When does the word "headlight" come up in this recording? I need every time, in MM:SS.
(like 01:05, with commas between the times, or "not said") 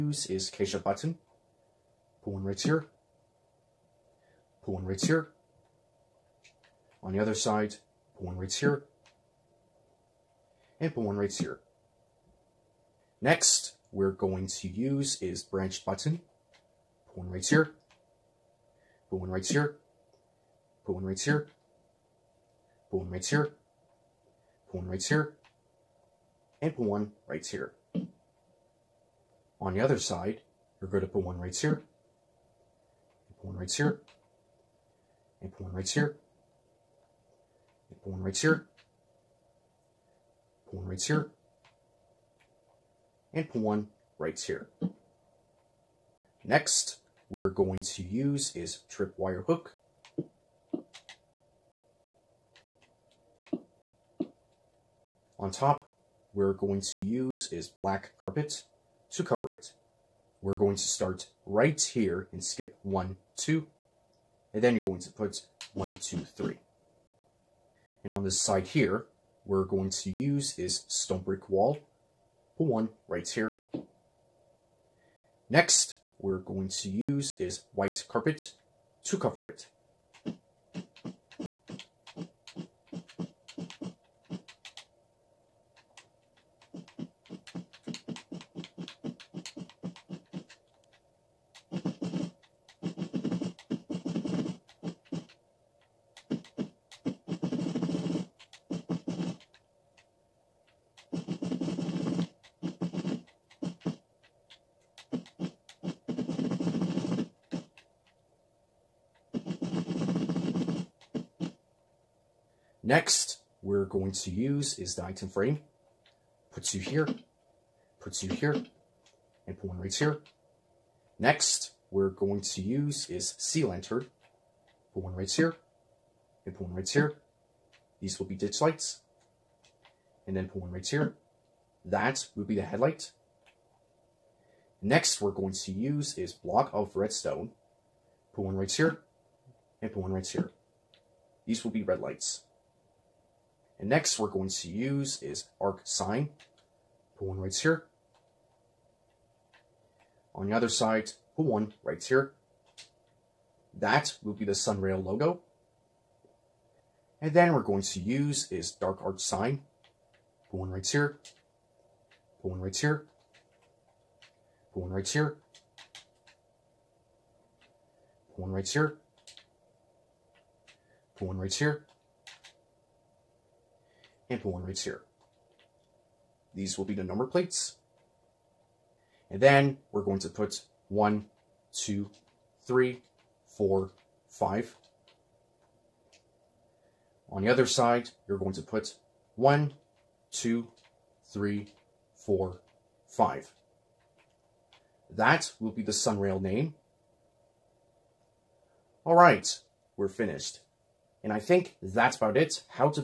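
02:12.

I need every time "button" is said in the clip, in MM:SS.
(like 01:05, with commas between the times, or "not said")
00:00, 00:15.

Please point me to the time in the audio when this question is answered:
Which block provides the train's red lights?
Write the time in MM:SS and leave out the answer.
02:16.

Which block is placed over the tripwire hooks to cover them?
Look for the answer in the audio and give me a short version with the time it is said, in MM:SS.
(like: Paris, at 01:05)
Black carpet, at 00:57.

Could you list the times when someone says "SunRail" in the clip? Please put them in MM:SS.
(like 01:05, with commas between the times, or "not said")
02:34, 03:15.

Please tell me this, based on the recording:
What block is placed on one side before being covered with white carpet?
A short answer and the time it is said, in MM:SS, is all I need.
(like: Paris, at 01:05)
Stone brick wall, at 01:10.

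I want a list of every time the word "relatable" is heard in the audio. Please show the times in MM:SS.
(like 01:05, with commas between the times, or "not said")
not said.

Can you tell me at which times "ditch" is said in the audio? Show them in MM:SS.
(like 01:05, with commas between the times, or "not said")
02:08.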